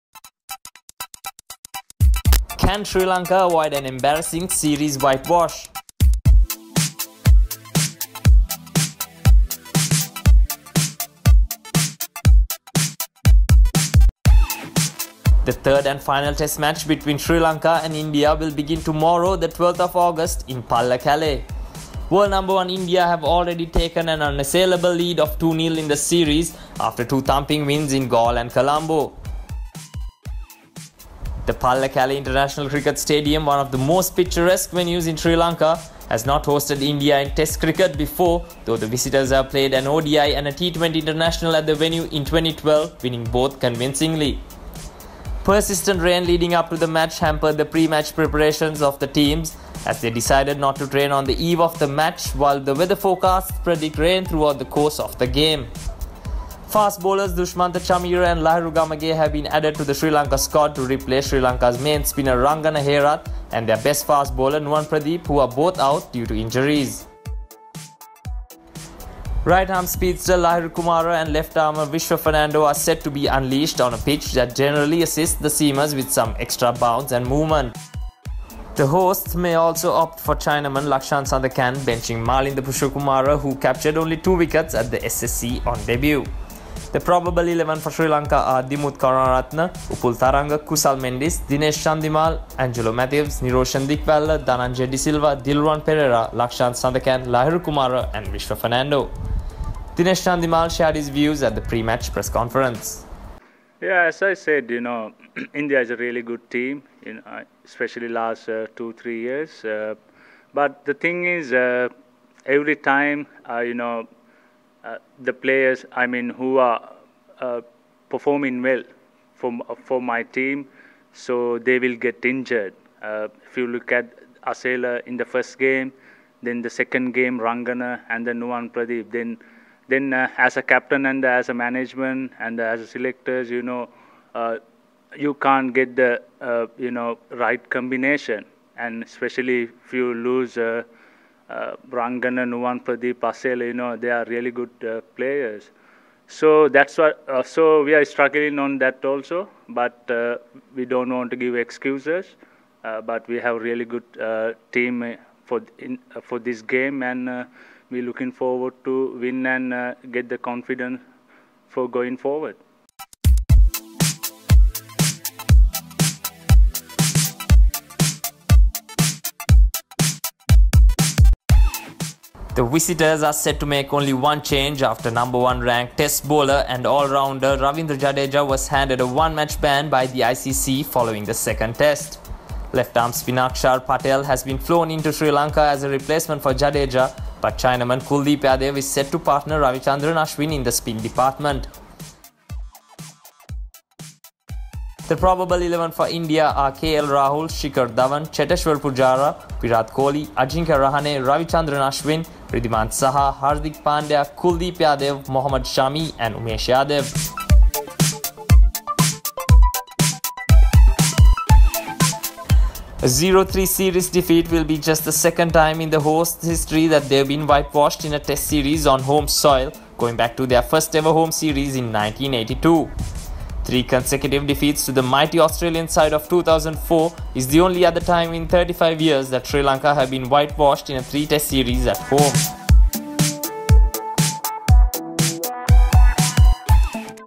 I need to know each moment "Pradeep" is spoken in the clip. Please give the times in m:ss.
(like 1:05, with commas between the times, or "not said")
1:04, 2:08, 2:22.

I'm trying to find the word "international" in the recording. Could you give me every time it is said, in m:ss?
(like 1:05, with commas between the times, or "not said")
0:32, 0:40.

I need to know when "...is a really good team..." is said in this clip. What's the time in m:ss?
1:45.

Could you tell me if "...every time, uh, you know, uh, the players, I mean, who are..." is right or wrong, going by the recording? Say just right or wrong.
right.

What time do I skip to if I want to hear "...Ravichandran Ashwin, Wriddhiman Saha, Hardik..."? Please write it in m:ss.
3:21.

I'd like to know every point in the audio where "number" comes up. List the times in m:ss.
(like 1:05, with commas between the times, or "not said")
0:22, 2:55.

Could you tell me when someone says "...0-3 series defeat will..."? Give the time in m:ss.
3:33.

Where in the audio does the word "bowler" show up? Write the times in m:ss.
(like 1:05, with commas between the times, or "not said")
0:57, 1:04, 2:56.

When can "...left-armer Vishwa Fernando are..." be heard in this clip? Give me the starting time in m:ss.
1:11.